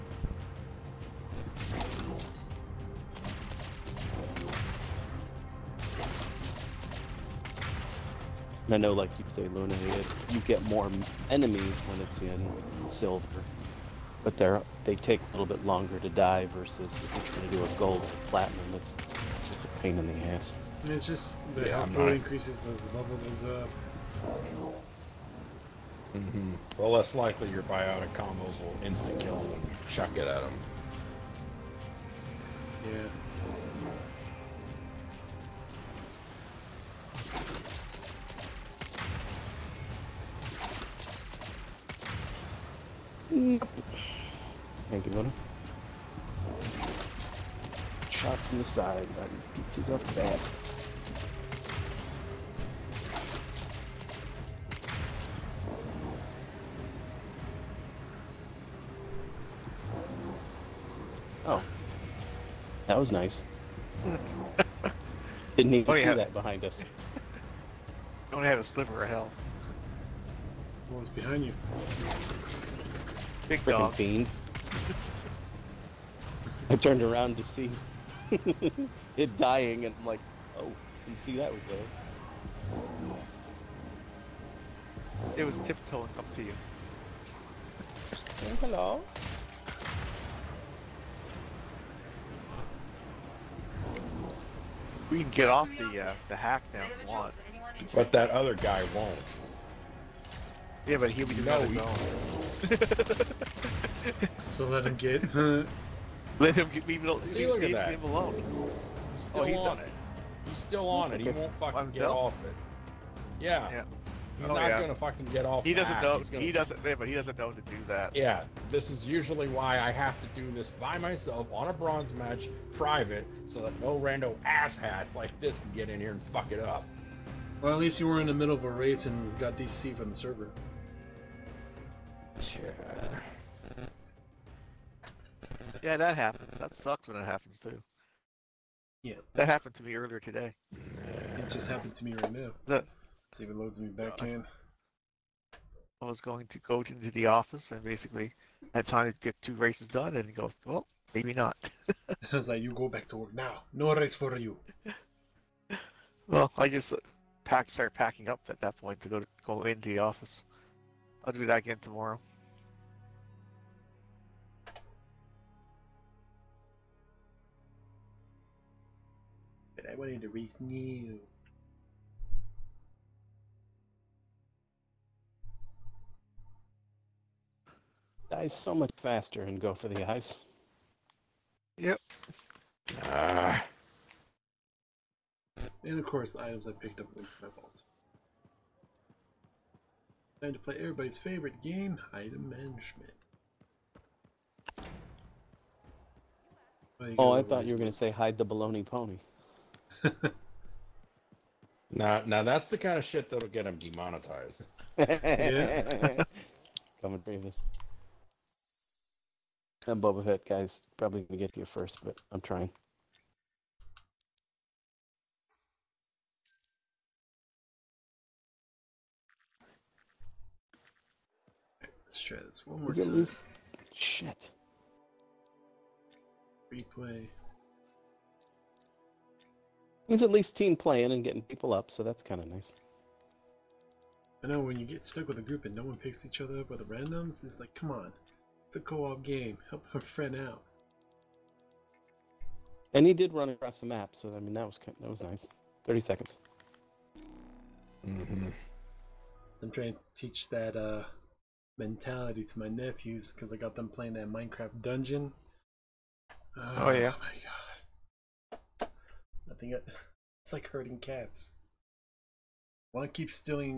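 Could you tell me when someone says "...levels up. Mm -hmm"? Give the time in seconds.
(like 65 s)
22 s.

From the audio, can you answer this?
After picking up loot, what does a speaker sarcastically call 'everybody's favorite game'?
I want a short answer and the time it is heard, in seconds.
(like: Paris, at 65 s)
Item management, at 192 s.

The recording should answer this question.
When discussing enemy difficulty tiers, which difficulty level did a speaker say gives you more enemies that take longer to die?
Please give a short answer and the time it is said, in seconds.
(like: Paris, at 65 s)
Silver, at 12 s.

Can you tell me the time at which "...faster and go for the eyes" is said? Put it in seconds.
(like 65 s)
178 s.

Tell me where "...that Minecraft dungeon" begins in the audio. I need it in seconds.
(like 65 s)
254 s.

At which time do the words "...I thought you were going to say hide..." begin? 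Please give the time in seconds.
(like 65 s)
197 s.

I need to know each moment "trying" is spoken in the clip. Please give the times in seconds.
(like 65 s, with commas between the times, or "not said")
17 s, 212 s, 249 s.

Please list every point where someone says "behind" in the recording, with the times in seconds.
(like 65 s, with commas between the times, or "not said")
66 s, 71 s.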